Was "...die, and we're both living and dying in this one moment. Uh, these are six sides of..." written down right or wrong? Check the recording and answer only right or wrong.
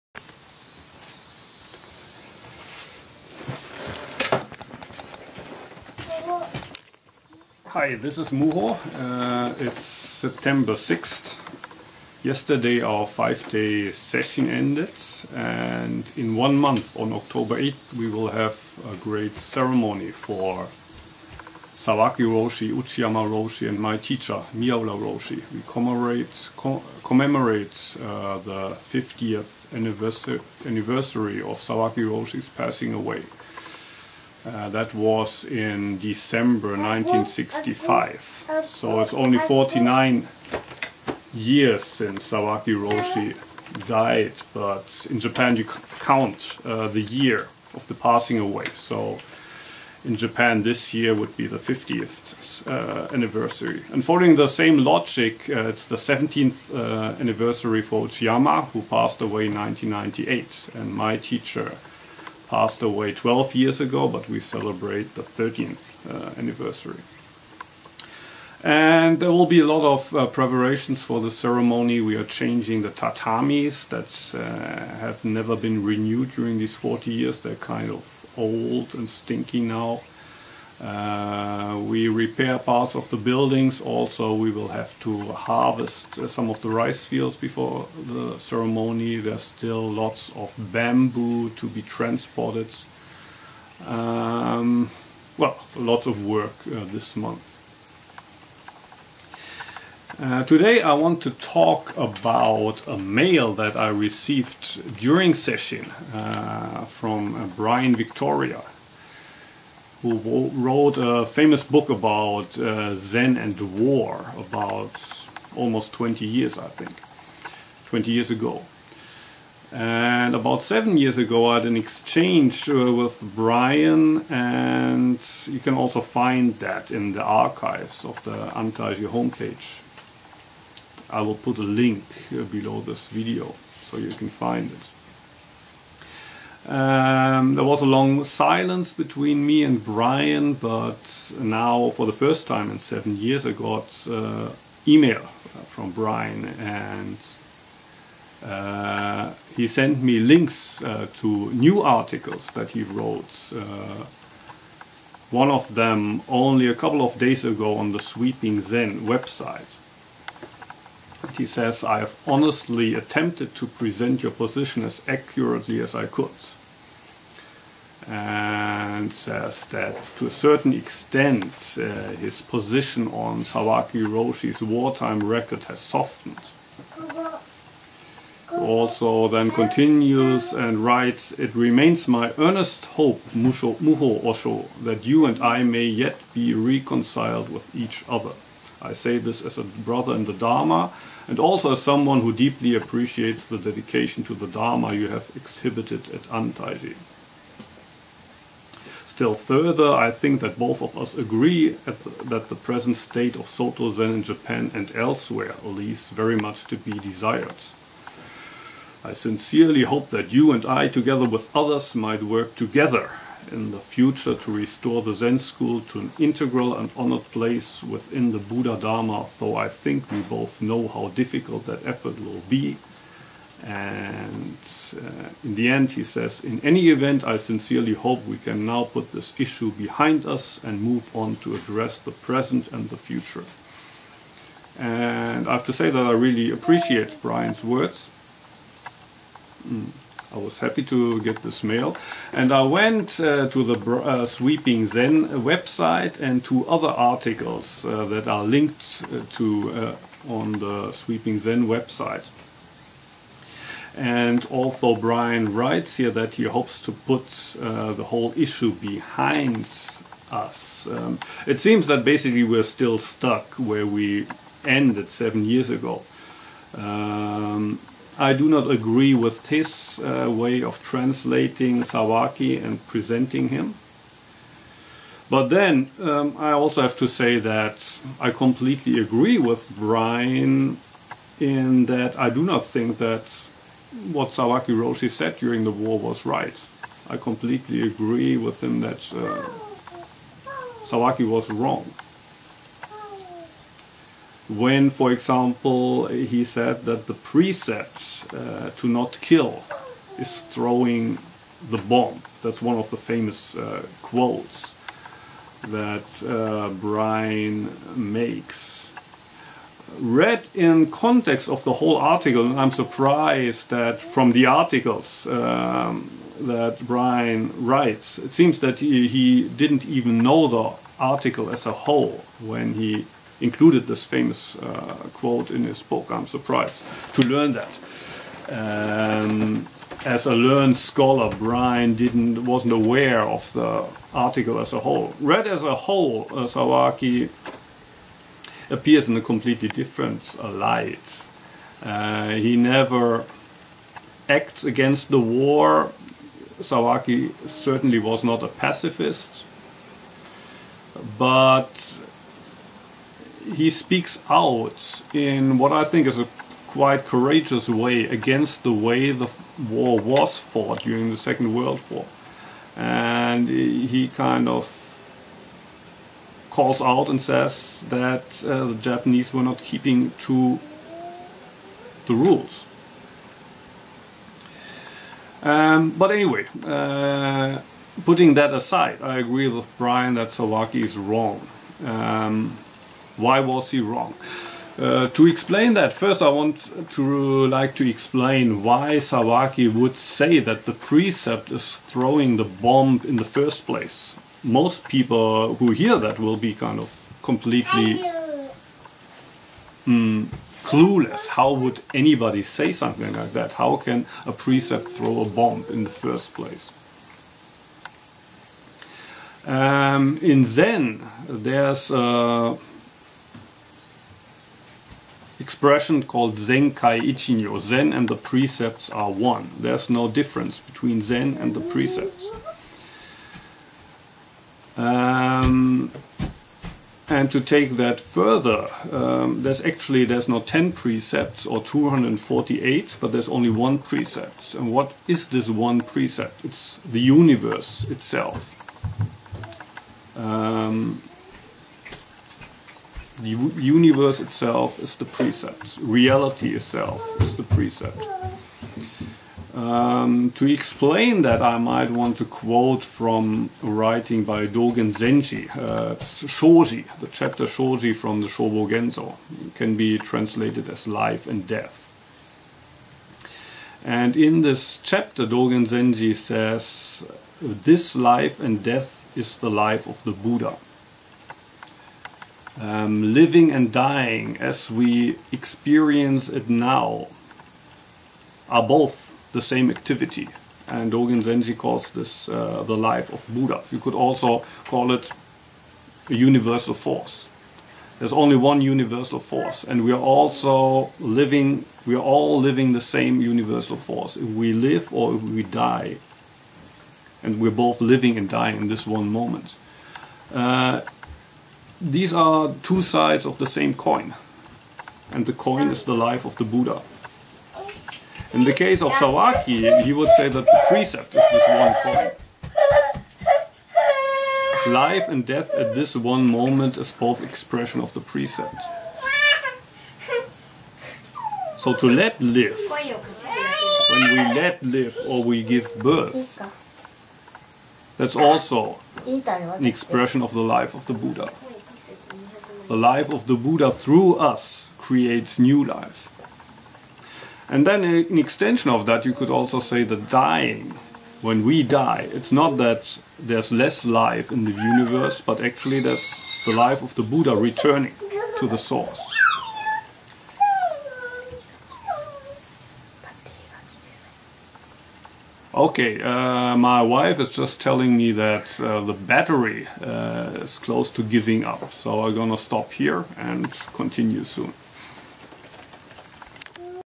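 wrong.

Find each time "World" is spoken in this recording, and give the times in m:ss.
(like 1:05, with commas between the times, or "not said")
6:01.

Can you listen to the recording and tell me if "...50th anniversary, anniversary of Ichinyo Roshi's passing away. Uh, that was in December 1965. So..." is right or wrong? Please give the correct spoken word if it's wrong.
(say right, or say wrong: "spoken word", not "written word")
wrong: "Sawaki", not "Ichinyo".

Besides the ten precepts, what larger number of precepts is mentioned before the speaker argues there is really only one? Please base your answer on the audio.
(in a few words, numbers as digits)
248.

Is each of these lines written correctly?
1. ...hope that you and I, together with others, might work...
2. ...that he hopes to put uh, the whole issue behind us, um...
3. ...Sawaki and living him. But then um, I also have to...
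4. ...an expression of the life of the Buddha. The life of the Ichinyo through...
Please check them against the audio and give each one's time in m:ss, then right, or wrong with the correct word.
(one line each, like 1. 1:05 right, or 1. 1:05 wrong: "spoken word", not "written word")
1. 3:29 right
2. 4:16 right
3. 4:31 wrong: "presenting", not "living"
4. 8:49 wrong: "Buddha", not "Ichinyo".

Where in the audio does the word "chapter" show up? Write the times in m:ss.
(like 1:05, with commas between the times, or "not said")
7:37, 7:44.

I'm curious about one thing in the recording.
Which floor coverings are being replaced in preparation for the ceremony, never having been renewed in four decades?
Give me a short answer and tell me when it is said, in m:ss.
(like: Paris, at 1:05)
tatamis, at 1:12.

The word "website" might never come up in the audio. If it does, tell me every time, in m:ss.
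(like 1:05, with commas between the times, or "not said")
2:39, 4:05, 4:11.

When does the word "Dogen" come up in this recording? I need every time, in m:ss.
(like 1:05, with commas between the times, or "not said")
7:34, 7:45, 8:00.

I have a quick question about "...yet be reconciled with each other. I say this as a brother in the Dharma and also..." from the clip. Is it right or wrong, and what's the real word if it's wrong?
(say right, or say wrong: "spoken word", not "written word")
right.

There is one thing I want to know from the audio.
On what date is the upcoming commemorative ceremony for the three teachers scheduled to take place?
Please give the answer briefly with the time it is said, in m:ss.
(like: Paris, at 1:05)
October 8th, at 0:17.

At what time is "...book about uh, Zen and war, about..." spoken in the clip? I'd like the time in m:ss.
1:51.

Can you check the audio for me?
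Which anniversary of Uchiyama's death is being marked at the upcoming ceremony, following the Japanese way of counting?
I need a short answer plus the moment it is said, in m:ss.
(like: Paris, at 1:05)
17th, at 0:55.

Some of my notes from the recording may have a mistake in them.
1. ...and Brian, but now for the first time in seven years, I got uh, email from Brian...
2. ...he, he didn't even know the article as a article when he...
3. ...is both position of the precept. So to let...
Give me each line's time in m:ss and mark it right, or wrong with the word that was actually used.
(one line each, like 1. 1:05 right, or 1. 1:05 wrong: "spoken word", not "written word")
1. 2:19 right
2. 5:18 wrong: "whole", not "article"
3. 8:36 wrong: "expression", not "position".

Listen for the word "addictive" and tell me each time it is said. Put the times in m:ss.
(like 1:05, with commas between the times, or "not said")
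not said.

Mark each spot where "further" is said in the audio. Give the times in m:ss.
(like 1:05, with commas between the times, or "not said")
3:19, 7:08.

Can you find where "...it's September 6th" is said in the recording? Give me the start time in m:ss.
0:09.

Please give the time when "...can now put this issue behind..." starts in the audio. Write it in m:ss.
3:48.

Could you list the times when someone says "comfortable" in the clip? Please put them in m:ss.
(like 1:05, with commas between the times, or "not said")
not said.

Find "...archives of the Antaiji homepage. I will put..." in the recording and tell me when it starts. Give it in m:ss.
2:07.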